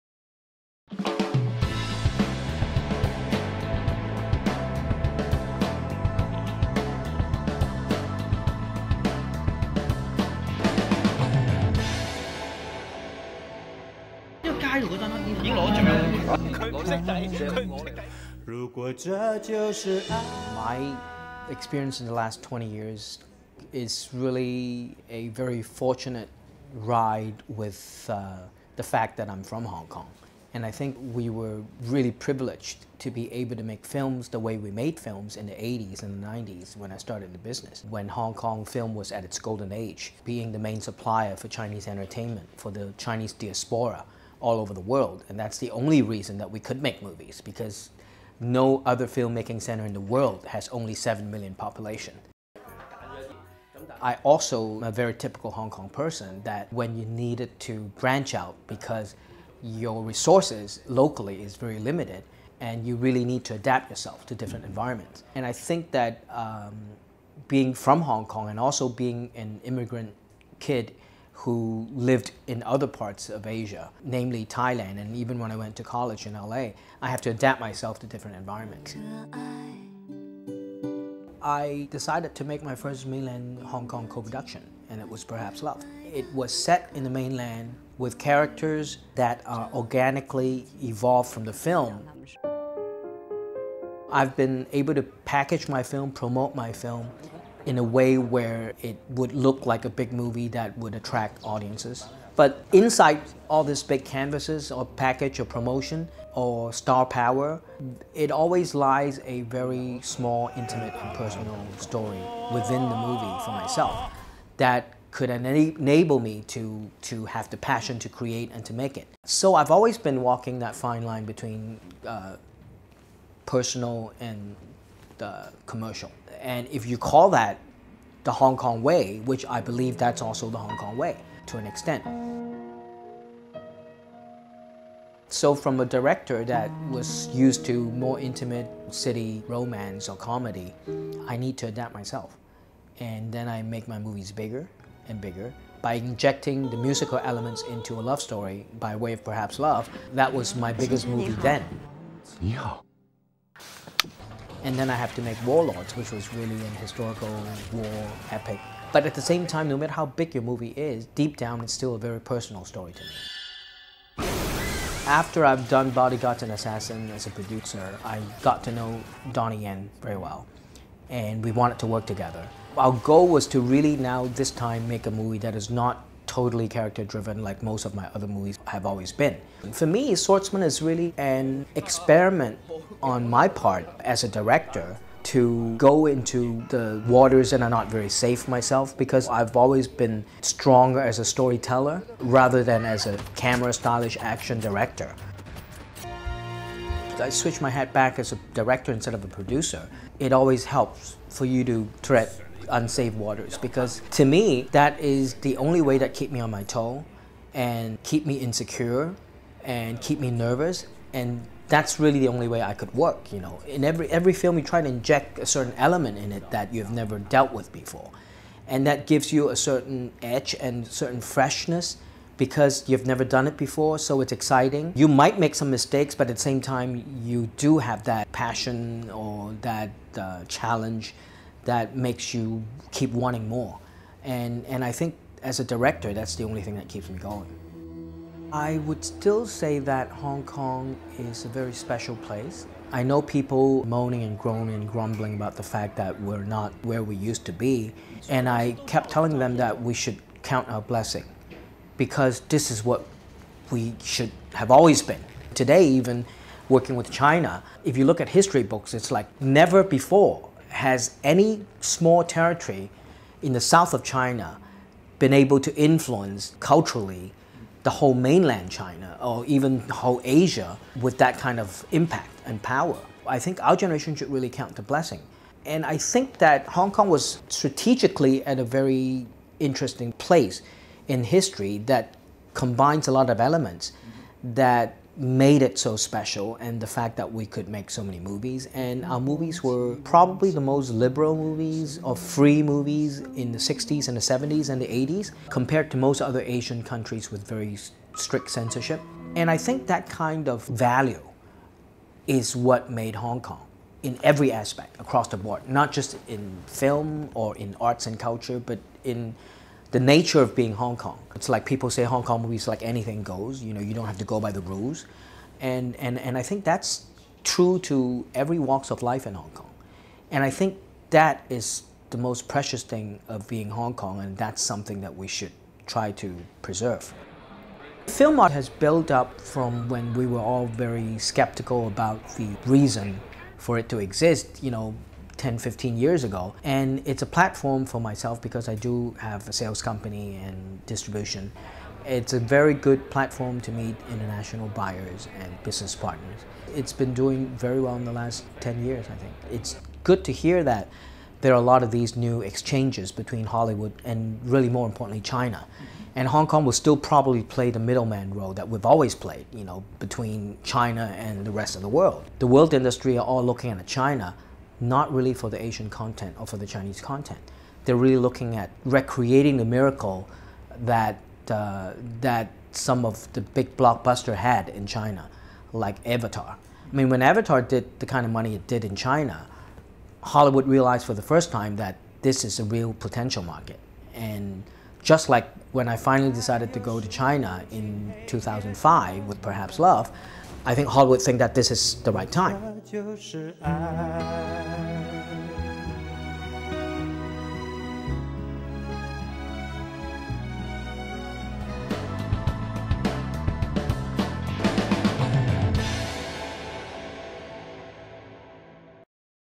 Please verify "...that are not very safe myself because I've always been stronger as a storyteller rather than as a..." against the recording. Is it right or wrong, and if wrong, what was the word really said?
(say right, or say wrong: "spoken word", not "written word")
right.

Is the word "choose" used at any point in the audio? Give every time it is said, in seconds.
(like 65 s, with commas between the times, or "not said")
not said.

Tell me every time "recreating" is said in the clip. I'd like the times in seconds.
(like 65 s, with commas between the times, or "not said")
368 s.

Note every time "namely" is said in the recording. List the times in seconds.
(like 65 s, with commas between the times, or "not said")
74 s.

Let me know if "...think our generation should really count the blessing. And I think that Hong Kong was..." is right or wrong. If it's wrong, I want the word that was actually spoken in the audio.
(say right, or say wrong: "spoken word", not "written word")
right.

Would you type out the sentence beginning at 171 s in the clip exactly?
And we wanted to work together.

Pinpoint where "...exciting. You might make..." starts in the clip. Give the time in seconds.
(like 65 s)
224 s.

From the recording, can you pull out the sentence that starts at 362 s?
The world industry are all looking at China not really for the Asian content or for the Chinese content.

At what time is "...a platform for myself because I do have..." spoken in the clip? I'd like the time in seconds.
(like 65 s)
337 s.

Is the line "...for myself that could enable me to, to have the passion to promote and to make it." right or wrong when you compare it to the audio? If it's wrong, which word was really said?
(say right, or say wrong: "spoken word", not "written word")
wrong: "create", not "promote".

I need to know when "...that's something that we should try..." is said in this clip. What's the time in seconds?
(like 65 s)
324 s.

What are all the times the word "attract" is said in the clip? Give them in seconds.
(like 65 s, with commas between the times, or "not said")
100 s.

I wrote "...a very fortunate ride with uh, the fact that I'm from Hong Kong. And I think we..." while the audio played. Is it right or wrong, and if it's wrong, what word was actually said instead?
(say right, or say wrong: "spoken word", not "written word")
right.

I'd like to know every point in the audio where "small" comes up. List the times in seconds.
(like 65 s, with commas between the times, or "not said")
110 s, 261 s.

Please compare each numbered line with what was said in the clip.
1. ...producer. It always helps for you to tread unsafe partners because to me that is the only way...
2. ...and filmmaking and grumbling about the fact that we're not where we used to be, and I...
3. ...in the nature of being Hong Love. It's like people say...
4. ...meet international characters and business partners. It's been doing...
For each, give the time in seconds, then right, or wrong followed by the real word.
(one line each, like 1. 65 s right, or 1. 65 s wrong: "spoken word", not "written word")
1. 199 s wrong: "waters", not "partners"
2. 244 s wrong: "groaning", not "filmmaking"
3. 309 s wrong: "Kong", not "Love"
4. 343 s wrong: "buyers", not "characters".